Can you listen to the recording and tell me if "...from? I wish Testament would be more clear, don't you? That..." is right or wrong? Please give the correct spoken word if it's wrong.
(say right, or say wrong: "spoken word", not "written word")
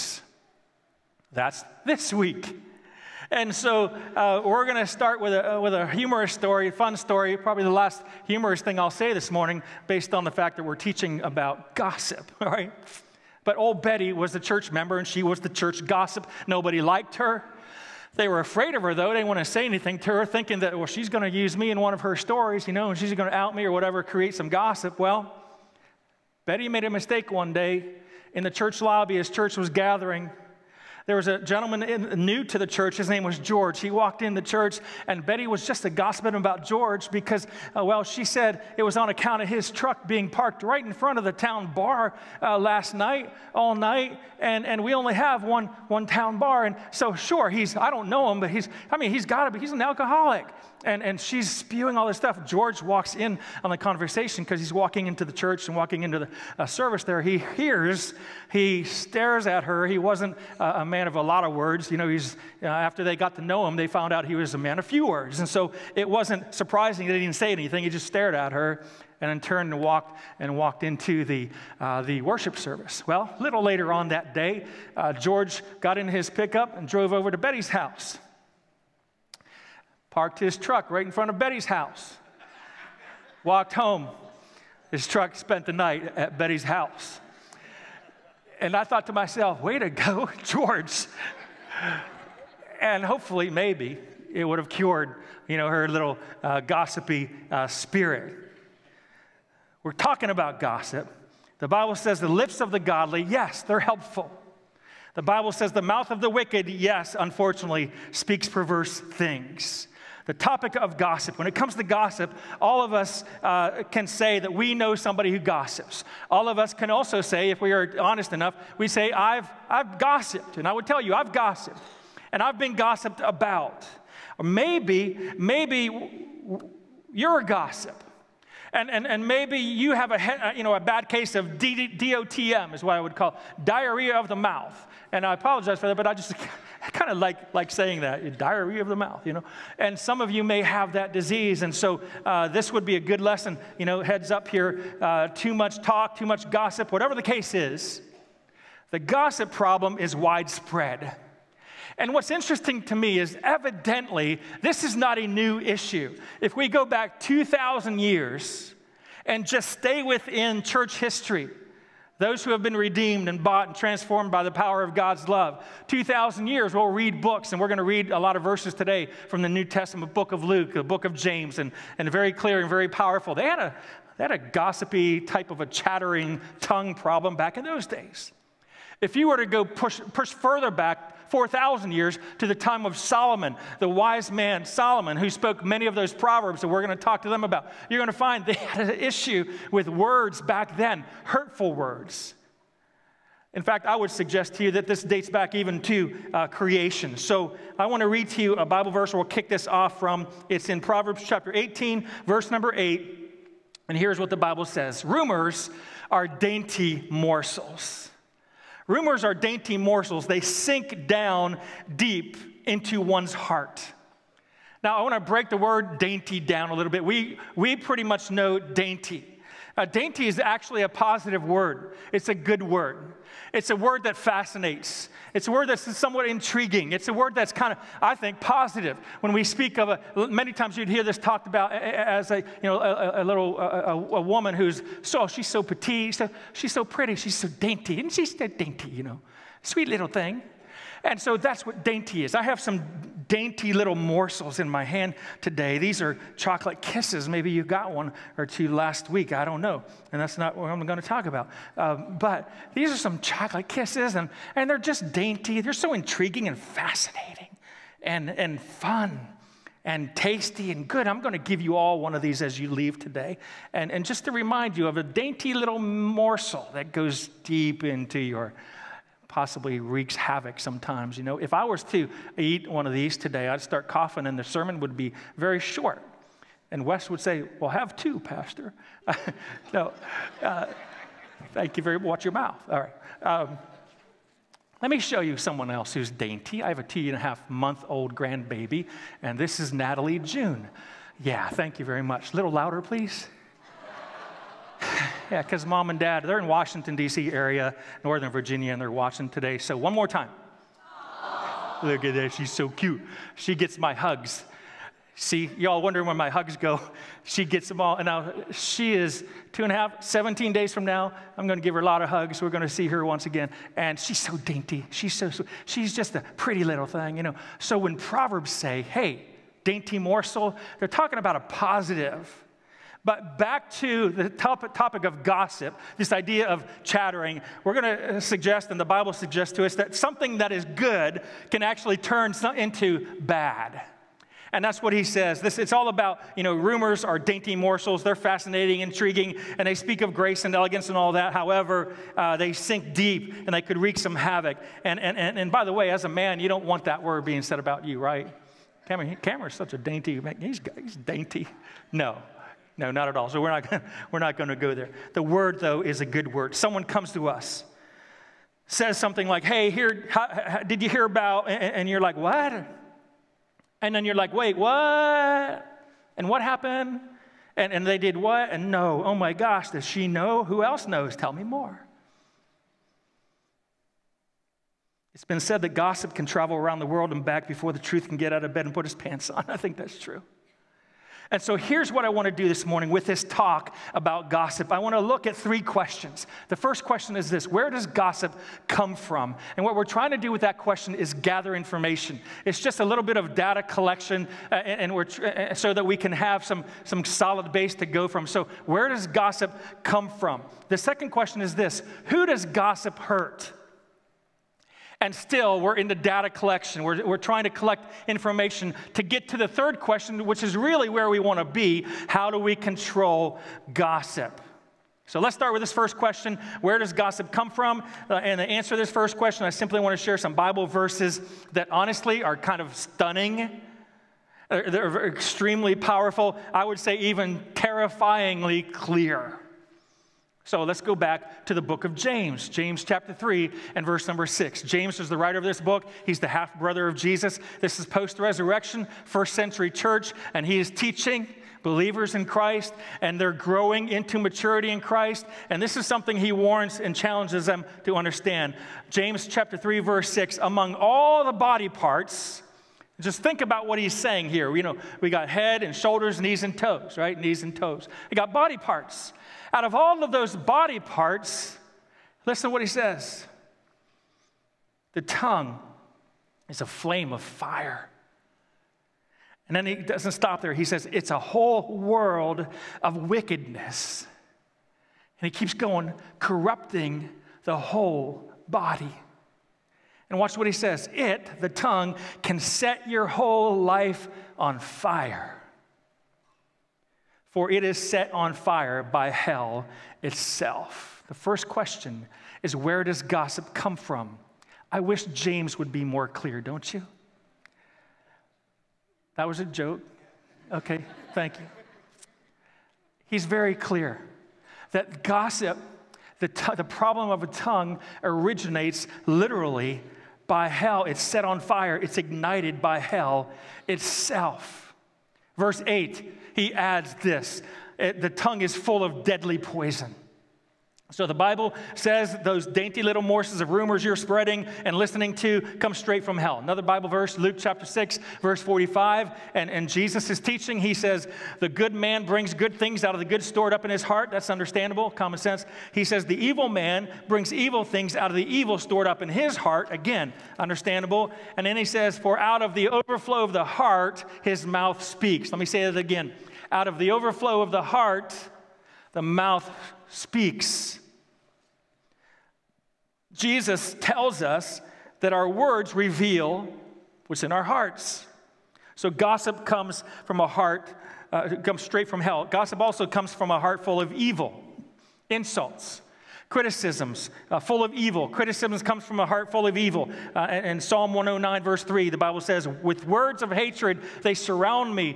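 wrong: "James", not "Testament".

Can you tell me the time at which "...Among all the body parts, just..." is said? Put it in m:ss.
7:30.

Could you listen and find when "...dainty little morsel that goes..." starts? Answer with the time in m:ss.
4:25.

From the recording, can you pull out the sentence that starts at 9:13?
Jesus tells us that our words reveal what's in our hearts.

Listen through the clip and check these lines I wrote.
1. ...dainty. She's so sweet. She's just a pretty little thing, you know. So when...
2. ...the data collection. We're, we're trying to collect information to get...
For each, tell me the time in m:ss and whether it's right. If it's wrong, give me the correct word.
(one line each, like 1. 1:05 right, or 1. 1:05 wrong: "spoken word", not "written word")
1. 5:14 right
2. 6:45 right.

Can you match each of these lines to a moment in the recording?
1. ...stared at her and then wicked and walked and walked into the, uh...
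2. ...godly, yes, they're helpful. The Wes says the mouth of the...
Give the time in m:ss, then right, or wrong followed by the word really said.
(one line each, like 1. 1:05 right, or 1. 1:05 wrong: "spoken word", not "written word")
1. 1:08 wrong: "turned", not "wicked"
2. 1:42 wrong: "Bible", not "Wes".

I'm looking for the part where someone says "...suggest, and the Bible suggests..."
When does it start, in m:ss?
5:28.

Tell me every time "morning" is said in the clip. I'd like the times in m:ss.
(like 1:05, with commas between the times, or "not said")
0:09, 6:22.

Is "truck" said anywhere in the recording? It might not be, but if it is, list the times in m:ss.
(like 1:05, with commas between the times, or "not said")
0:39, 1:20, 1:25.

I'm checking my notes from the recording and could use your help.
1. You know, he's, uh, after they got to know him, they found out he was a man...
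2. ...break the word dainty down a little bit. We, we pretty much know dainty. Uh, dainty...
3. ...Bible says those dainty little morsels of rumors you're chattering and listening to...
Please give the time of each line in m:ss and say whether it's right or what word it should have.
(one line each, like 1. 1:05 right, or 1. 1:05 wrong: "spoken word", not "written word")
1. 1:01 right
2. 3:35 right
3. 8:41 wrong: "spreading", not "chattering".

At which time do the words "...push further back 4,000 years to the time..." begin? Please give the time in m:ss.
3:00.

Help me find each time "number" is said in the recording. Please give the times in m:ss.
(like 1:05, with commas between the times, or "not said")
3:22, 7:14.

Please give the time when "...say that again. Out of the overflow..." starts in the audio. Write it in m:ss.
9:05.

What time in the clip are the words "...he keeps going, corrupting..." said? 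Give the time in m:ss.
7:55.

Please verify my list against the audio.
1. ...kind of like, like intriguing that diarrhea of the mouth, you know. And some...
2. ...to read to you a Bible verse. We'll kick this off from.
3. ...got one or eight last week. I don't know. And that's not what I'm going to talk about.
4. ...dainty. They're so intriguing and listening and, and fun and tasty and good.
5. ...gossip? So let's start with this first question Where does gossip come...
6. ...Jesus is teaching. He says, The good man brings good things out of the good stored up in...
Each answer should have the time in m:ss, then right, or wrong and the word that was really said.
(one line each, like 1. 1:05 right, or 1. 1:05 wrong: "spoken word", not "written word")
1. 2:16 wrong: "saying", not "intriguing"
2. 3:18 right
3. 4:07 wrong: "two", not "eight"
4. 4:15 wrong: "fascinating", not "listening"
5. 6:53 right
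6. 8:49 right.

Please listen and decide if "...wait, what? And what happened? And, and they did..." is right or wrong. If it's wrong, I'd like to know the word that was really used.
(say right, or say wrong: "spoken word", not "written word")
right.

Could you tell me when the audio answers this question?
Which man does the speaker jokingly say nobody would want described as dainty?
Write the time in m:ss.
5:49.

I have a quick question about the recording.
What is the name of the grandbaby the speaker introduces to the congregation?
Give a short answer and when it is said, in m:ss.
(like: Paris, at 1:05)
Natalie June, at 4:49.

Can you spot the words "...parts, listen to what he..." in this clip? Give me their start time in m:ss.
7:40.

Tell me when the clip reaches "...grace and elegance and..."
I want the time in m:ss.
5:40.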